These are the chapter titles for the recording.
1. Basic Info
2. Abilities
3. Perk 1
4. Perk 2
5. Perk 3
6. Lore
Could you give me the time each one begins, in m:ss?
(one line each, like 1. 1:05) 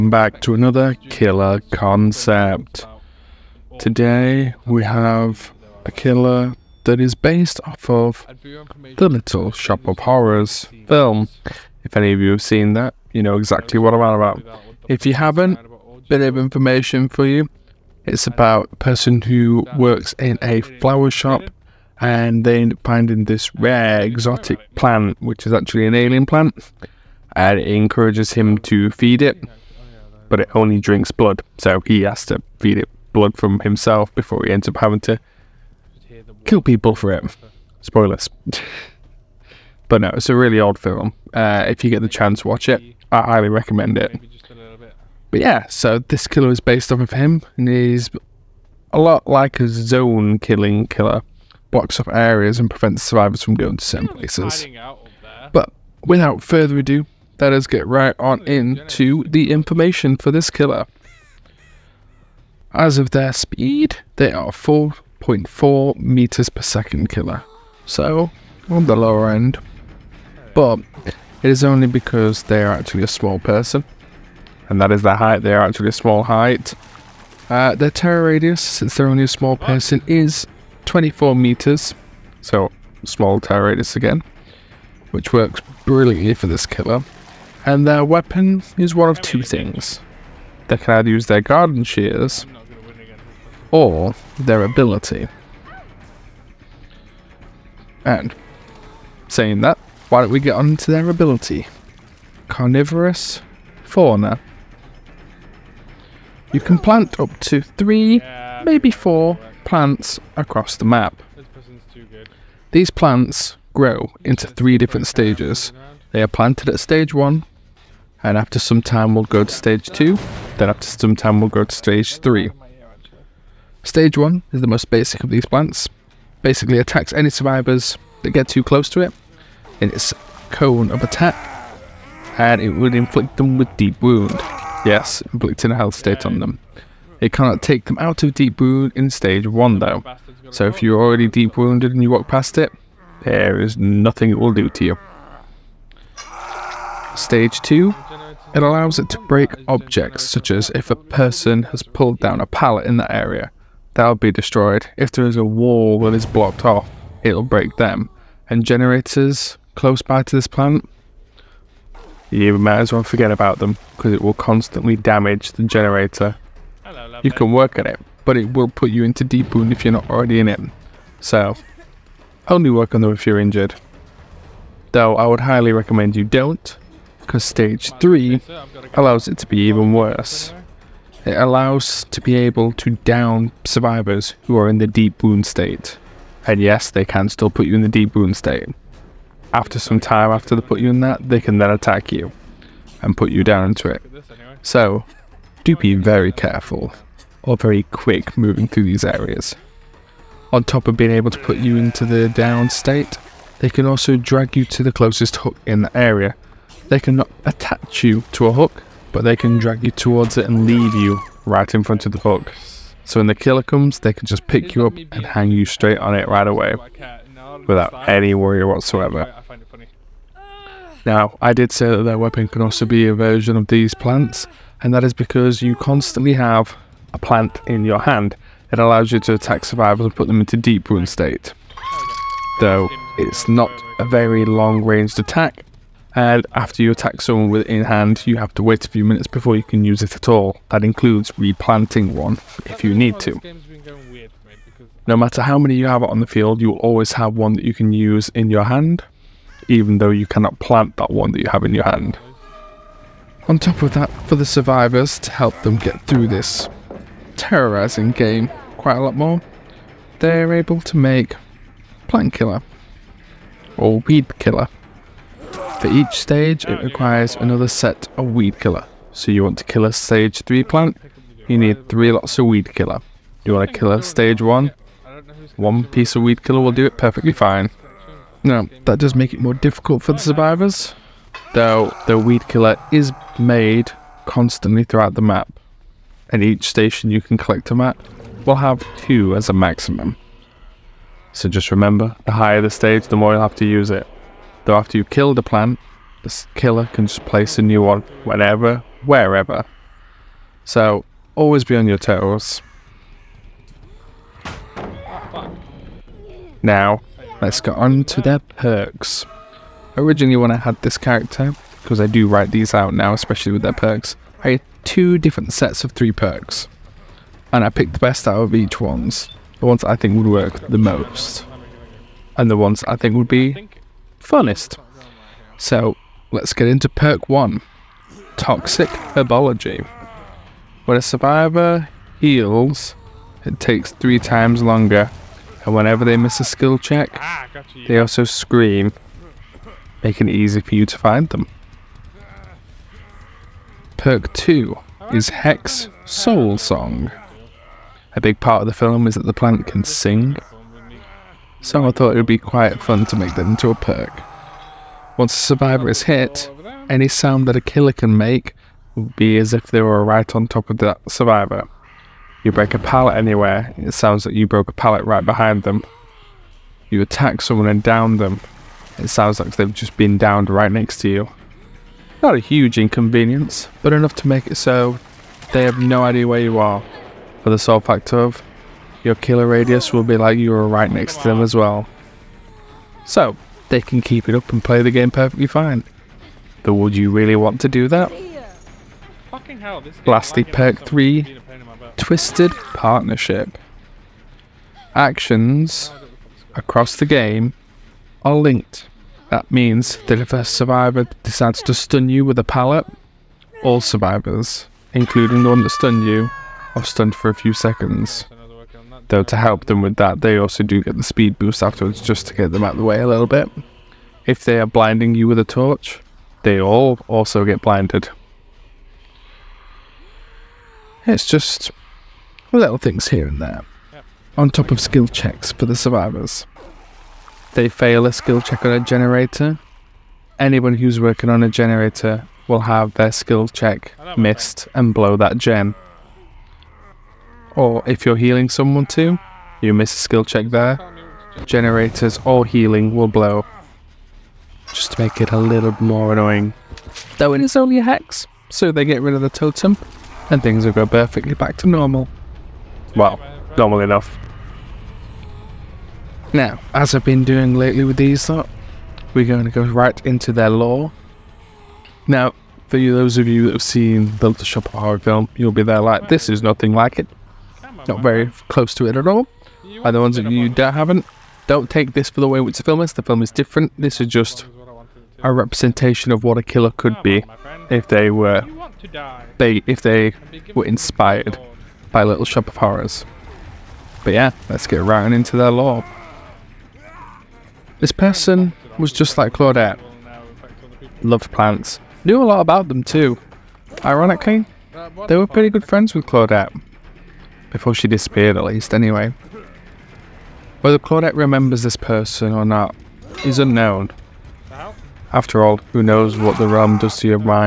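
1. 0:59
2. 1:40
3. 5:26
4. 5:42
5. 6:29
6. 7:37.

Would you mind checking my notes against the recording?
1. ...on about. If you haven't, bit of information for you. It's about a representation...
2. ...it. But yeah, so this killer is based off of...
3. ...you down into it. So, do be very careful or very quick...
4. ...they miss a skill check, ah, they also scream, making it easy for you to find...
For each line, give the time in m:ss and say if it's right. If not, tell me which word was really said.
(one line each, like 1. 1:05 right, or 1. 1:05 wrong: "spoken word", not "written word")
1. 0:13 wrong: "person", not "representation"
2. 0:43 right
3. 3:13 right
4. 5:36 right.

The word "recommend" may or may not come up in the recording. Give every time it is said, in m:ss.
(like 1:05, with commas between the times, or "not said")
0:43, 2:55.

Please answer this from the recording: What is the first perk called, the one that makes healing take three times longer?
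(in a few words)
Toxic Herbology.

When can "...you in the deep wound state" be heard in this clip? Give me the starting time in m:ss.
3:07.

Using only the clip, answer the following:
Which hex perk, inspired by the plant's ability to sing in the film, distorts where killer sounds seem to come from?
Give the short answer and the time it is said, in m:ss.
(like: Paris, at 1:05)
Hex Soul Song, at 5:45.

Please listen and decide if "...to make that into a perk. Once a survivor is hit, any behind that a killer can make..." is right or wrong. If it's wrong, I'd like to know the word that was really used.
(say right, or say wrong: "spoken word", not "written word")
wrong: "sound", not "behind".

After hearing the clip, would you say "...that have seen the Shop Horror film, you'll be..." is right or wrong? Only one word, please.
right.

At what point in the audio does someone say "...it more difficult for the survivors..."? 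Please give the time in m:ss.
4:39.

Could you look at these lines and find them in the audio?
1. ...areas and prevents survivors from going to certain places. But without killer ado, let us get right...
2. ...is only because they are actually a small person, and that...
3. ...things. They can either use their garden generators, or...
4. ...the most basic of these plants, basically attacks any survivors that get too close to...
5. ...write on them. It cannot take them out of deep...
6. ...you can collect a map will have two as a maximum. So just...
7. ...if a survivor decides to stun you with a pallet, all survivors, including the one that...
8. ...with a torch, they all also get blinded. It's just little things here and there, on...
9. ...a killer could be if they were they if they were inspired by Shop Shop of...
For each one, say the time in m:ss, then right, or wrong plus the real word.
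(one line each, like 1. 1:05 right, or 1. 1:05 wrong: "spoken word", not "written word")
1. 0:52 wrong: "further", not "killer"
2. 1:11 right
3. 1:29 wrong: "shears", not "generators"
4. 2:04 right
5. 2:15 wrong: "state", not "write"
6. 4:47 right
7. 6:40 right
8. 6:55 right
9. 7:56 wrong: "Little", not "Shop".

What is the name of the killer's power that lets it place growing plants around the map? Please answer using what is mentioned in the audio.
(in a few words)
Carnivorous Fauna.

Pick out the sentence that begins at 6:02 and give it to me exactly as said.
You break a pallet anywhere, it sounds like you broke a pallet right behind them.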